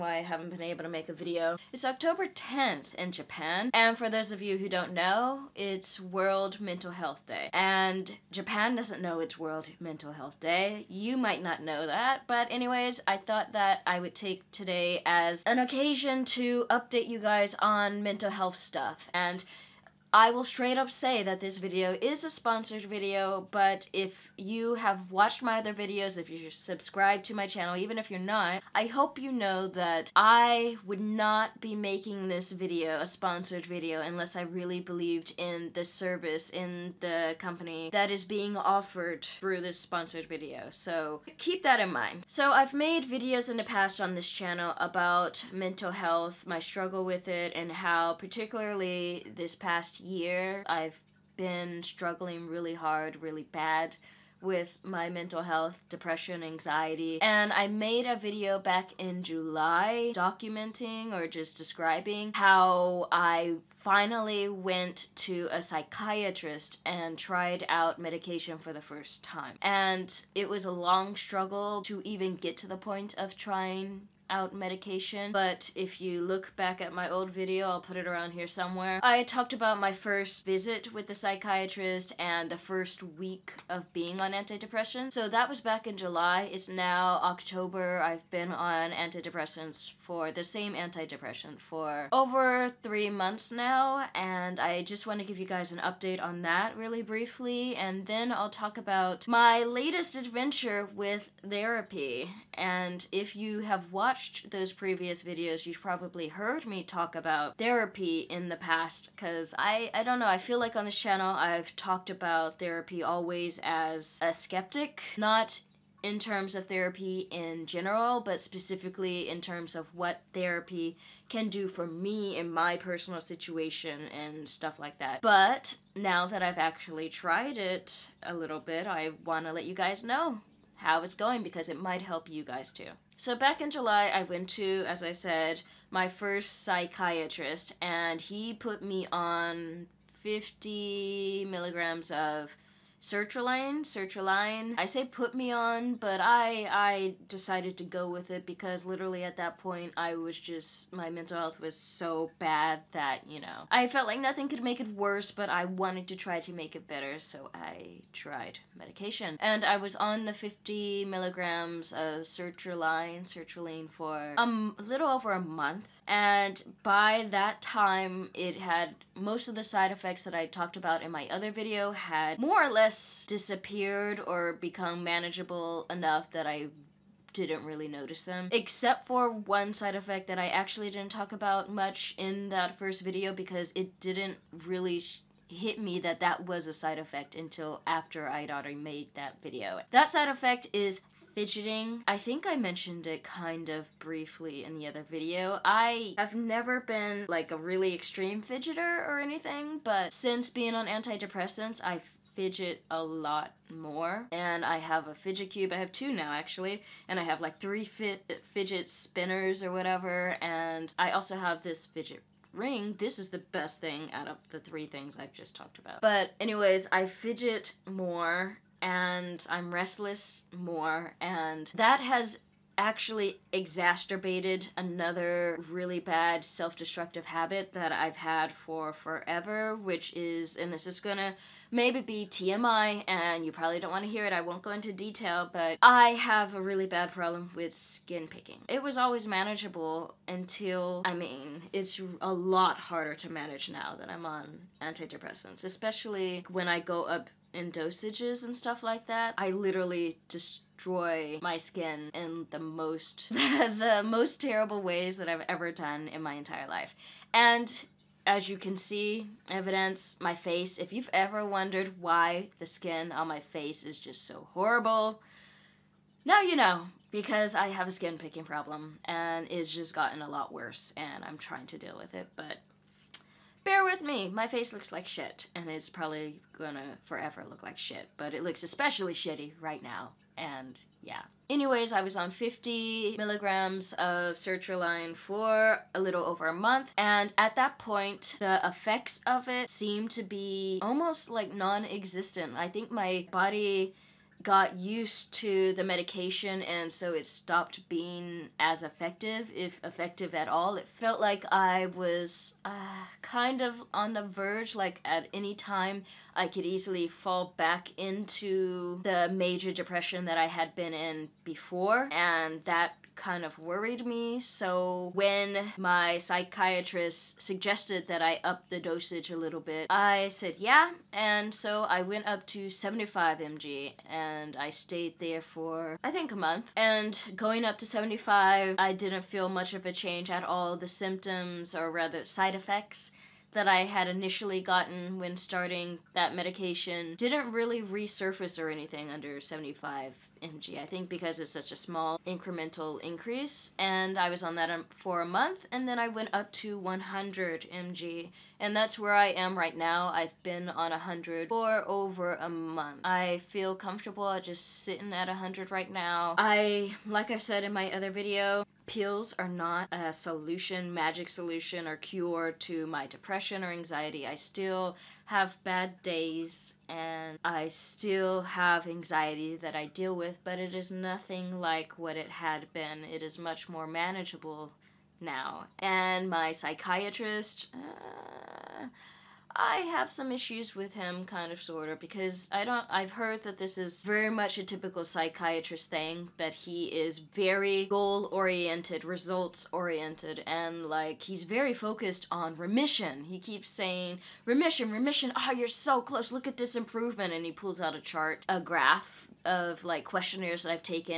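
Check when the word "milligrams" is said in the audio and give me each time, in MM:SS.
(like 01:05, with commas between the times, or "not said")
02:21, 02:41, 04:43.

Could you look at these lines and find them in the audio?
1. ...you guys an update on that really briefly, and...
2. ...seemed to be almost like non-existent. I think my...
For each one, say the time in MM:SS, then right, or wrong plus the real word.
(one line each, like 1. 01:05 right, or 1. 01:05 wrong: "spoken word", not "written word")
1. 01:35 right
2. 04:49 right.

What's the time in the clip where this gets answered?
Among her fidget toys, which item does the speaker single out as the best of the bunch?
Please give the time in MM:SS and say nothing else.
03:31.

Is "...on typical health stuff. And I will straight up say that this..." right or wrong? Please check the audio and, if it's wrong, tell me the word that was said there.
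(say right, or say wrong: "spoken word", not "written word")
wrong: "mental", not "typical".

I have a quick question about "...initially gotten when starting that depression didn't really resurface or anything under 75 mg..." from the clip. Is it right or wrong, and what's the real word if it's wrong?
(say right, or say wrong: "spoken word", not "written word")
wrong: "medication", not "depression".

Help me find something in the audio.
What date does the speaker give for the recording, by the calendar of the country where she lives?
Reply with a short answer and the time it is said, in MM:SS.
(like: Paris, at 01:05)
October 10th, at 00:01.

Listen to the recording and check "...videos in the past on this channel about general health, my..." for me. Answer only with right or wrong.
wrong.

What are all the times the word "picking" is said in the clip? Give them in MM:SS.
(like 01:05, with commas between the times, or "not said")
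03:58, 04:28.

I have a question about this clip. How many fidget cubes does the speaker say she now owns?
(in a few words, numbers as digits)
2.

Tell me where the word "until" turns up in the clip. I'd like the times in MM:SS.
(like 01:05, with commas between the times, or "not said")
03:07, 04:00.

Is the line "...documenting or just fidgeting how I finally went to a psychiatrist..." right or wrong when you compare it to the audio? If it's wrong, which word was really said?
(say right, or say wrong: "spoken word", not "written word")
wrong: "describing", not "fidgeting".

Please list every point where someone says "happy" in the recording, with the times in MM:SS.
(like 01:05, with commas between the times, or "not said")
not said.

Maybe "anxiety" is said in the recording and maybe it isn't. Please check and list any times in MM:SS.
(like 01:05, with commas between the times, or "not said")
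00:56, 06:03, 06:08.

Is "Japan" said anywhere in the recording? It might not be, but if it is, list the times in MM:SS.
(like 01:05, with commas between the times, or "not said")
00:03, 00:08.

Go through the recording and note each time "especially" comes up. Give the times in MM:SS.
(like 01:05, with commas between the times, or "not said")
04:05, 04:38.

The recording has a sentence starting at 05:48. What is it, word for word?
And that's where I am right now.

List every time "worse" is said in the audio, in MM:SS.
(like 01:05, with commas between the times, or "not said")
02:34, 04:30.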